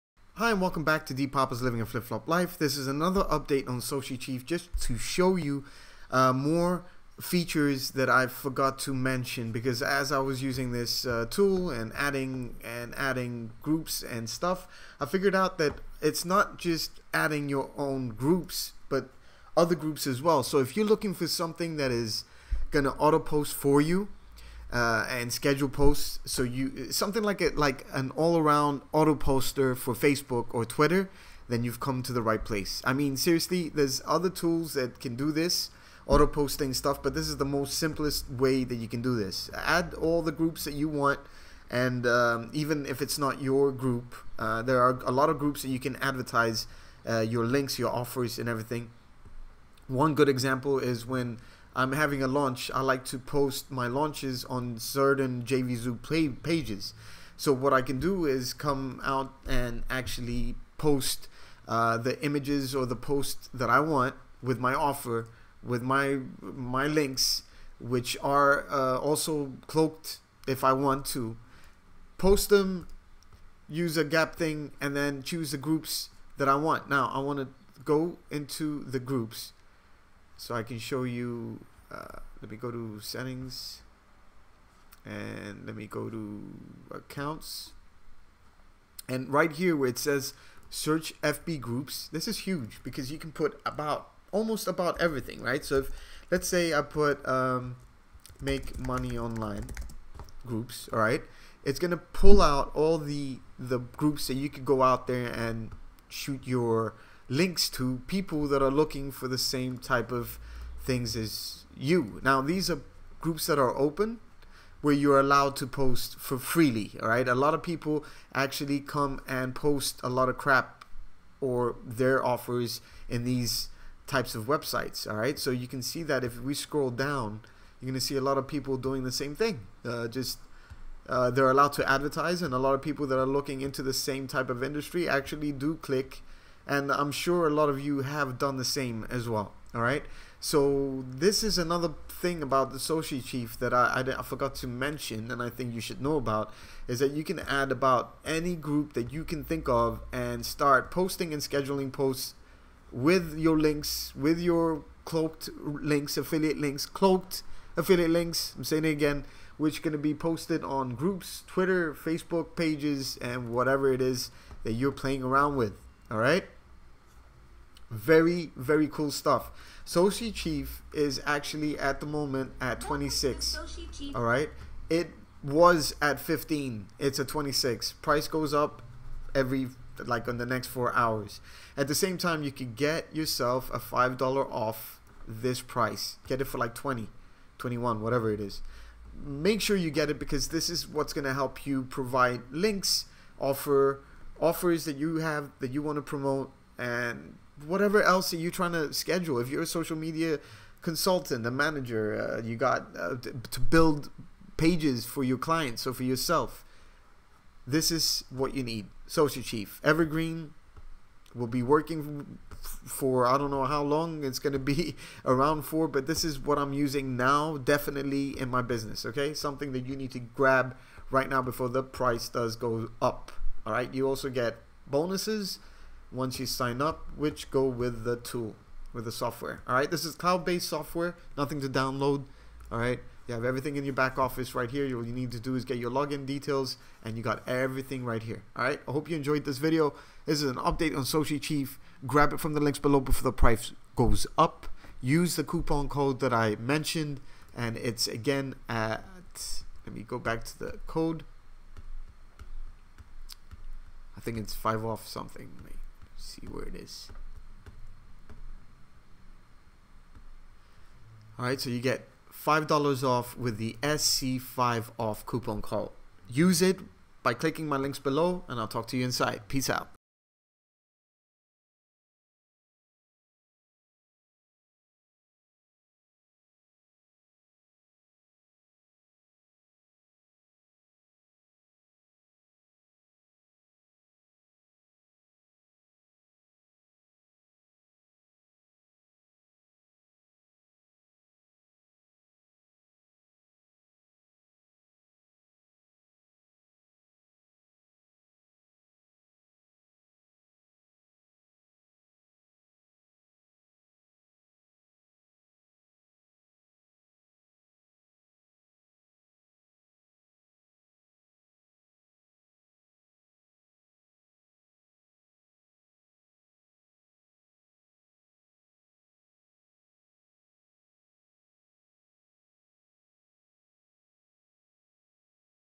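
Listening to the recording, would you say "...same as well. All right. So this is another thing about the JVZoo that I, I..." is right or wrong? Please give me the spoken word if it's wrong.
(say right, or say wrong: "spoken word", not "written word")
wrong: "Socichief", not "JVZoo".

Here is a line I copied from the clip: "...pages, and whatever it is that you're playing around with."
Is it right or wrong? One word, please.
right.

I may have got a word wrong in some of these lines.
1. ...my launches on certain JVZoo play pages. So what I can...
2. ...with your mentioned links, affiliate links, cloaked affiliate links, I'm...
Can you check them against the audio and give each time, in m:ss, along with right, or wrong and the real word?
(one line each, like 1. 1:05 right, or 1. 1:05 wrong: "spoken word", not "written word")
1. 0:53 right
2. 2:34 wrong: "cloaked", not "mentioned".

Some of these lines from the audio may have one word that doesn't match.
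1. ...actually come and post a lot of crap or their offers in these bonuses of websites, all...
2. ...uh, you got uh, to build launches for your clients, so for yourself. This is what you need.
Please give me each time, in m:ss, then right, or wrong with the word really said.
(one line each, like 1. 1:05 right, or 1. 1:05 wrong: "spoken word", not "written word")
1. 1:58 wrong: "types", not "bonuses"
2. 3:22 wrong: "pages", not "launches".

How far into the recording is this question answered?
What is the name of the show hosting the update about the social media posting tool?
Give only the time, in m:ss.
0:01.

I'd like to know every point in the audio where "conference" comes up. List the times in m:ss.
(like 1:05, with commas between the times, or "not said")
not said.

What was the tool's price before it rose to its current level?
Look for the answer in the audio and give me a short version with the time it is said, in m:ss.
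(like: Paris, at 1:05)
15, at 2:54.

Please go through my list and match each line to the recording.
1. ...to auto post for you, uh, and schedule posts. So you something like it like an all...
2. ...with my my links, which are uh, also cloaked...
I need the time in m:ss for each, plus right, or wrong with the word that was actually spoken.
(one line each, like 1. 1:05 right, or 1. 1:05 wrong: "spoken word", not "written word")
1. 0:22 right
2. 1:05 right.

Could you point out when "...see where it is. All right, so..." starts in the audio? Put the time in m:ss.
4:16.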